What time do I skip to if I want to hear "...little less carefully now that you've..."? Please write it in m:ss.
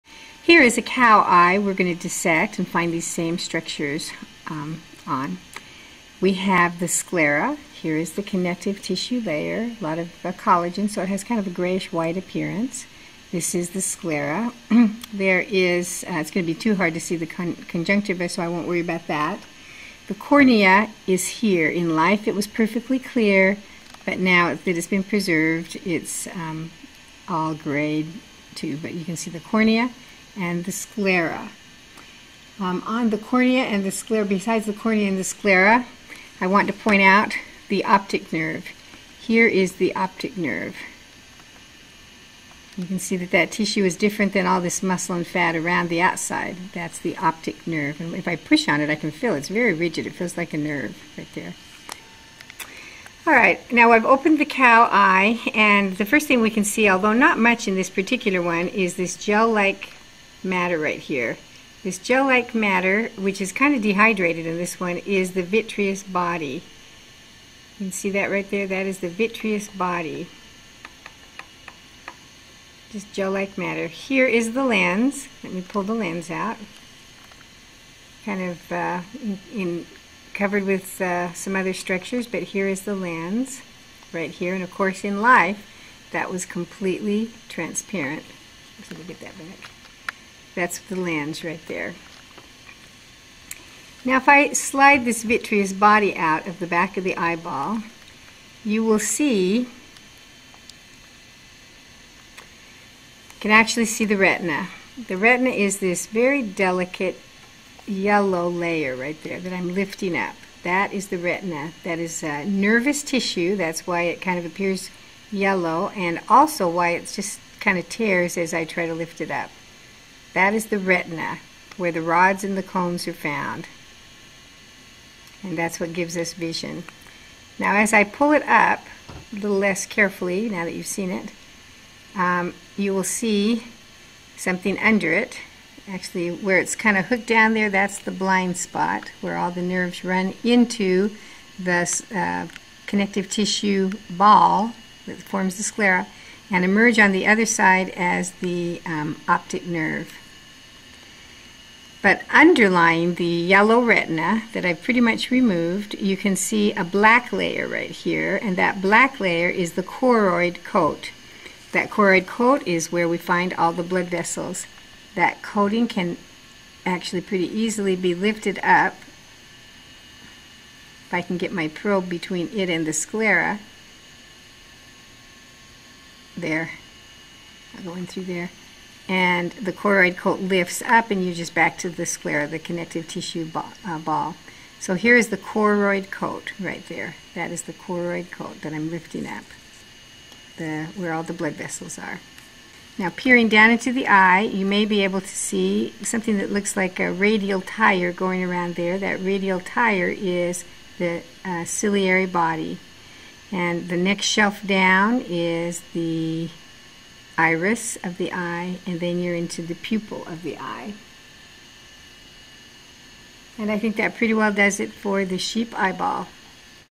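2:09.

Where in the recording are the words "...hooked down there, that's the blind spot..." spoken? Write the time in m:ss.
2:17.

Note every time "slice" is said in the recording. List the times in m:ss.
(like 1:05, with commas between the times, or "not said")
not said.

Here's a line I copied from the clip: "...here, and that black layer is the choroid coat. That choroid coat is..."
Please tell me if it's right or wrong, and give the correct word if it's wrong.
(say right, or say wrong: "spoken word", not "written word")
right.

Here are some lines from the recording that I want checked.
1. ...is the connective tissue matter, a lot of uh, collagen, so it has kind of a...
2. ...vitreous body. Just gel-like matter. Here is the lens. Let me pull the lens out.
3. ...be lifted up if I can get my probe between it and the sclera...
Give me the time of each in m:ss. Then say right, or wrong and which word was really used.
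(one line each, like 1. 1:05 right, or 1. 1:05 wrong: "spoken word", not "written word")
1. 0:07 wrong: "layer", not "matter"
2. 1:09 right
3. 2:47 right.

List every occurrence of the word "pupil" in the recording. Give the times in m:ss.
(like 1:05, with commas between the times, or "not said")
3:29.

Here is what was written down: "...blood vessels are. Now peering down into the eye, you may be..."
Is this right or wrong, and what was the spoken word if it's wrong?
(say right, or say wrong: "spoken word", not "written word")
right.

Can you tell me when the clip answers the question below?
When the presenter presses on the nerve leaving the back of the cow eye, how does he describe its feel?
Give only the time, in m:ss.
0:49.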